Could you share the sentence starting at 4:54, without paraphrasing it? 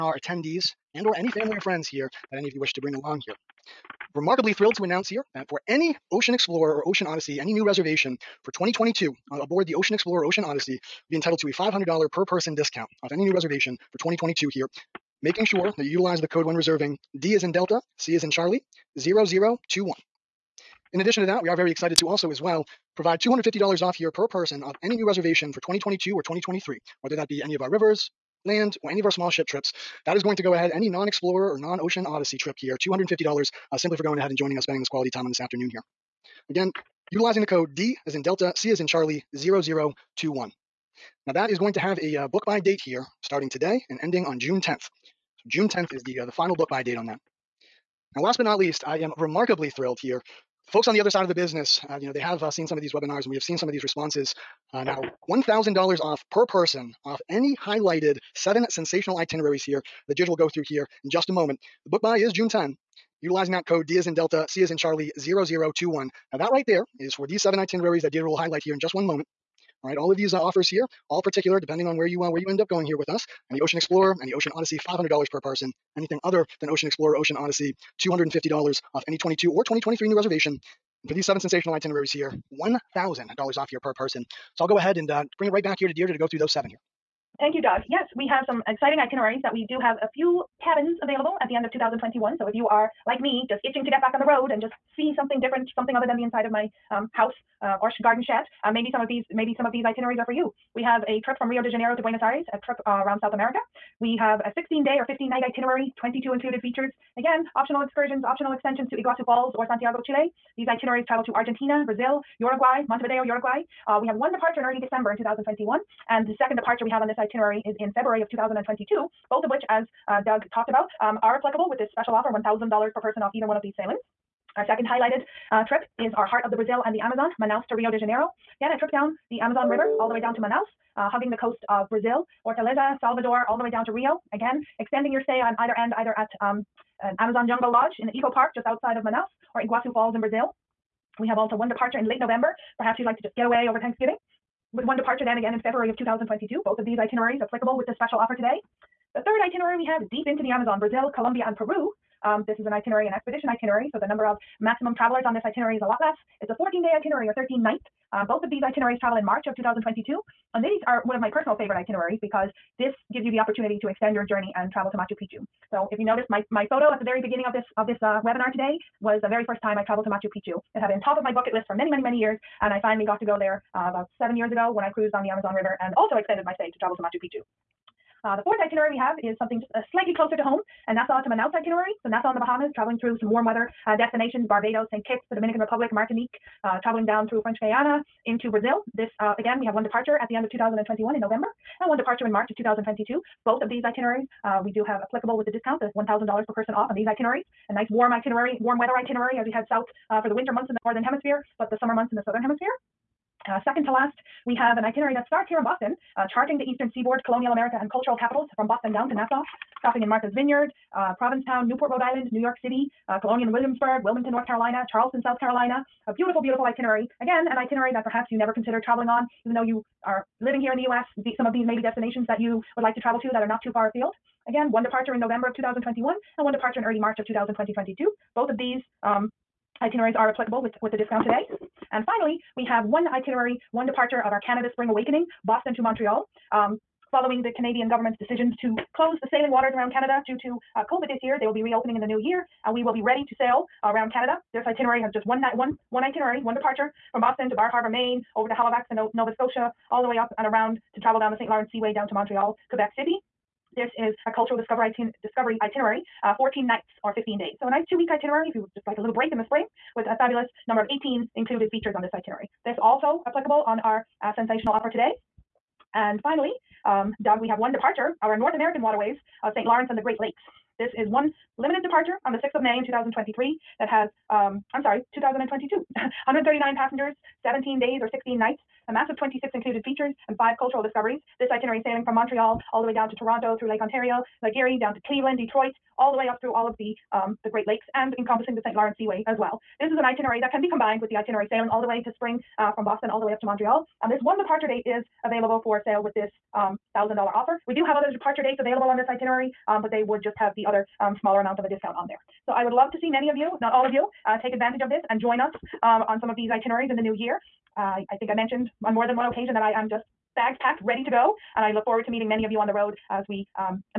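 And um, this one departure date is available for sale with this um, $1,000 offer.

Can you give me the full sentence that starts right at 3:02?
So Nassau in the Bahamas, traveling through some warm weather uh, destinations, Barbados, St.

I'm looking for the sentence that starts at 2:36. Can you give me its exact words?
It's a 14 day itinerary or 13 night.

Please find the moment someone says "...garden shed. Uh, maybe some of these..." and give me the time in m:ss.
1:38.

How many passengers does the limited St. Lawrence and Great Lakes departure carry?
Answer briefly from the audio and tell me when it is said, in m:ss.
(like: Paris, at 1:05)
139, at 4:35.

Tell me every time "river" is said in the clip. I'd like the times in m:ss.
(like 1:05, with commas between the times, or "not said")
0:27, 2:09, 2:55.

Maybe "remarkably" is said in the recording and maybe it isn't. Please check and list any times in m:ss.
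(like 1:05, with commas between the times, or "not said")
0:04, 0:49.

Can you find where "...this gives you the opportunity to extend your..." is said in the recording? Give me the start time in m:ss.
2:42.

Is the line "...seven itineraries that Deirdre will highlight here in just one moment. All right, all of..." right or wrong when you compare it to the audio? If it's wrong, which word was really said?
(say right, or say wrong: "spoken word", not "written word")
right.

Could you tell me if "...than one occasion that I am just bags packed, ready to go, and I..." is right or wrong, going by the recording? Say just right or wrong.
right.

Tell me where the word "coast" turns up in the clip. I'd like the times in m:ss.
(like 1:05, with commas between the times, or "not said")
2:11.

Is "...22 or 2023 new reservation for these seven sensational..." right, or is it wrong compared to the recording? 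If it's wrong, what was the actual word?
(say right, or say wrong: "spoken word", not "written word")
right.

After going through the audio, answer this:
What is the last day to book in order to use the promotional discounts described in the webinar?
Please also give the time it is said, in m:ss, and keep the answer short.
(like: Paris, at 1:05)
June 10, at 0:44.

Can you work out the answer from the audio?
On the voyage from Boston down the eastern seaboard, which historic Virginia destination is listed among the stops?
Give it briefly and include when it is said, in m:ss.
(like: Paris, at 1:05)
Colonial Williamsburg, at 3:33.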